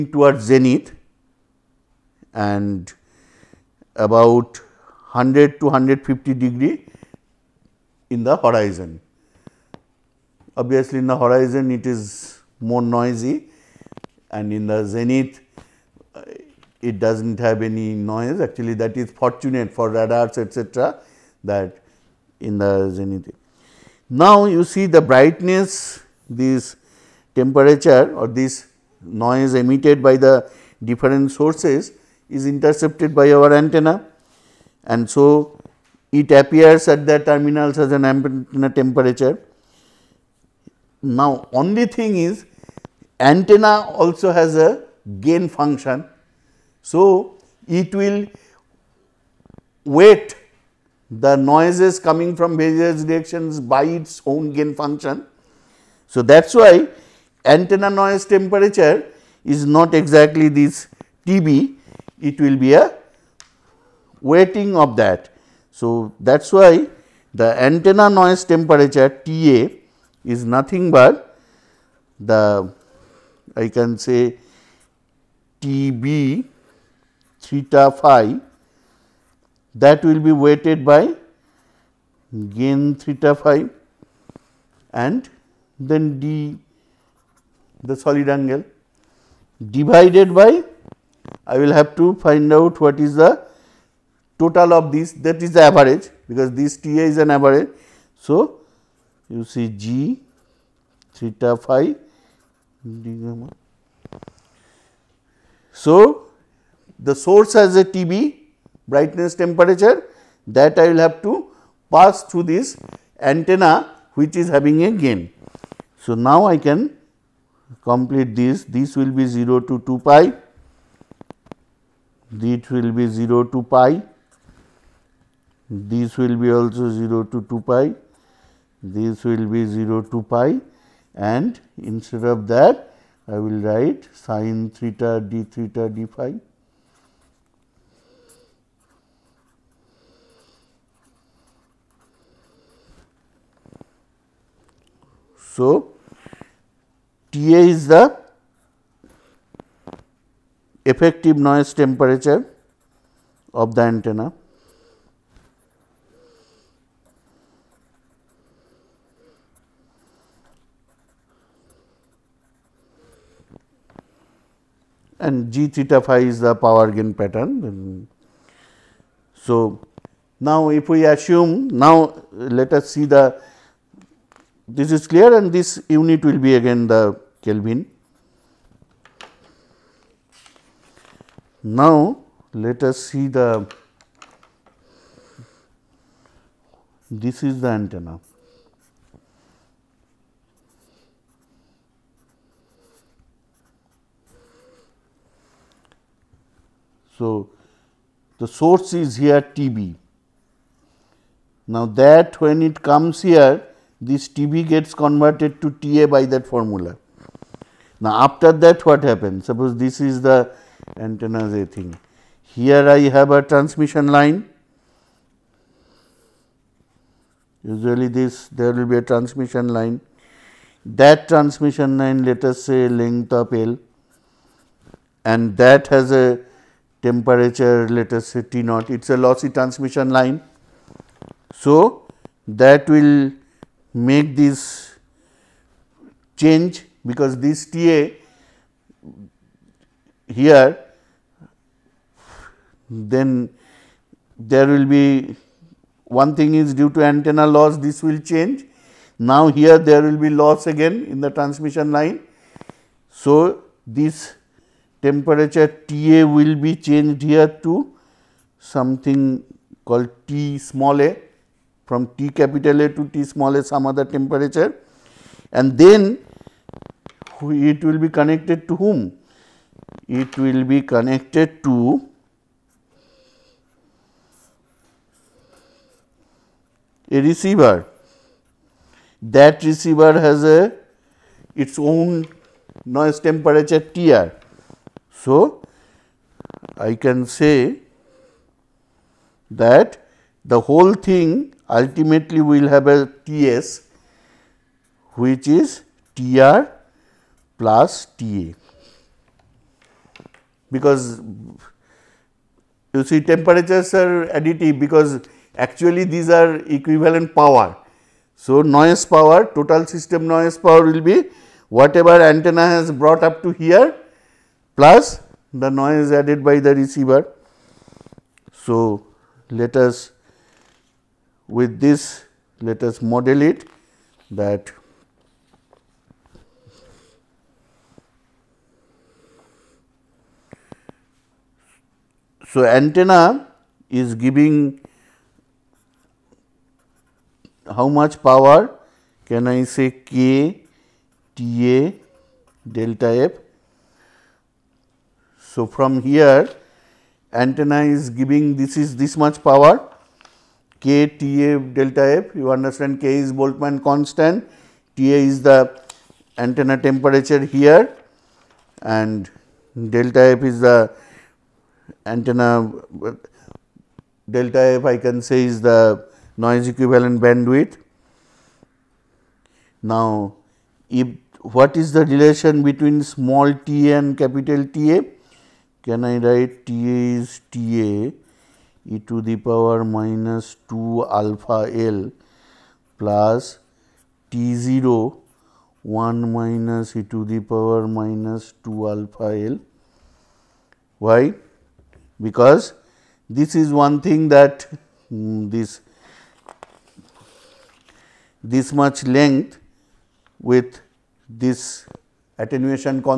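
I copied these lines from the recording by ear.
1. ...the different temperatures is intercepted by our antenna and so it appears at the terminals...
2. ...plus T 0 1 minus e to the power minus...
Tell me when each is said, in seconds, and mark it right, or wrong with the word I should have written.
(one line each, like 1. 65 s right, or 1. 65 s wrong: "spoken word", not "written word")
1. 30 s wrong: "sources", not "temperatures"
2. 383 s right.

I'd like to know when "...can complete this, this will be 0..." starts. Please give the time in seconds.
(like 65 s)
116 s.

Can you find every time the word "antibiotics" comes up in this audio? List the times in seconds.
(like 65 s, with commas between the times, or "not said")
not said.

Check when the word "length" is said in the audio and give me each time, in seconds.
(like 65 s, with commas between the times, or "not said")
222 s, 399 s.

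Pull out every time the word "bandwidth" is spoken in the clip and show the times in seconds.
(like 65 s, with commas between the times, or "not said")
367 s.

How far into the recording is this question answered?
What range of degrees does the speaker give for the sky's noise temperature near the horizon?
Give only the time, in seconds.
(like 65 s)
5 s.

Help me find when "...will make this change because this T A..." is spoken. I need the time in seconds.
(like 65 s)
232 s.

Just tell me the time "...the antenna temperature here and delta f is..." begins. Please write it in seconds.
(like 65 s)
355 s.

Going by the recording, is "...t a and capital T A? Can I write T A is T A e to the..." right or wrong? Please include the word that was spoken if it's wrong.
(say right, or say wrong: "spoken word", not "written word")
right.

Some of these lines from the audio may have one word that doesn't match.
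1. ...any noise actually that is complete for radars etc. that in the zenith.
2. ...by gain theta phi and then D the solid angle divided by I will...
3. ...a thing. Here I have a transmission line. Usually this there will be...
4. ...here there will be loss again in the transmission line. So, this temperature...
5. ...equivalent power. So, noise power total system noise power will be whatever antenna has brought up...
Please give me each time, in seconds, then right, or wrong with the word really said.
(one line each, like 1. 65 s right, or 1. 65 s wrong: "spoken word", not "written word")
1. 17 s wrong: "fortunate", not "complete"
2. 80 s right
3. 211 s right
4. 249 s right
5. 306 s right.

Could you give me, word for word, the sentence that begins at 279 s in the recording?
That receiver has a its own noise temperature T r.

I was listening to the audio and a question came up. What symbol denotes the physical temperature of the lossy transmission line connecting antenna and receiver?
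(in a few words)
T naught.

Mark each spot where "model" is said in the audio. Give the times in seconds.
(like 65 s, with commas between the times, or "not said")
323 s.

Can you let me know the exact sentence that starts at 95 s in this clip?
that is the average because this T A is an average.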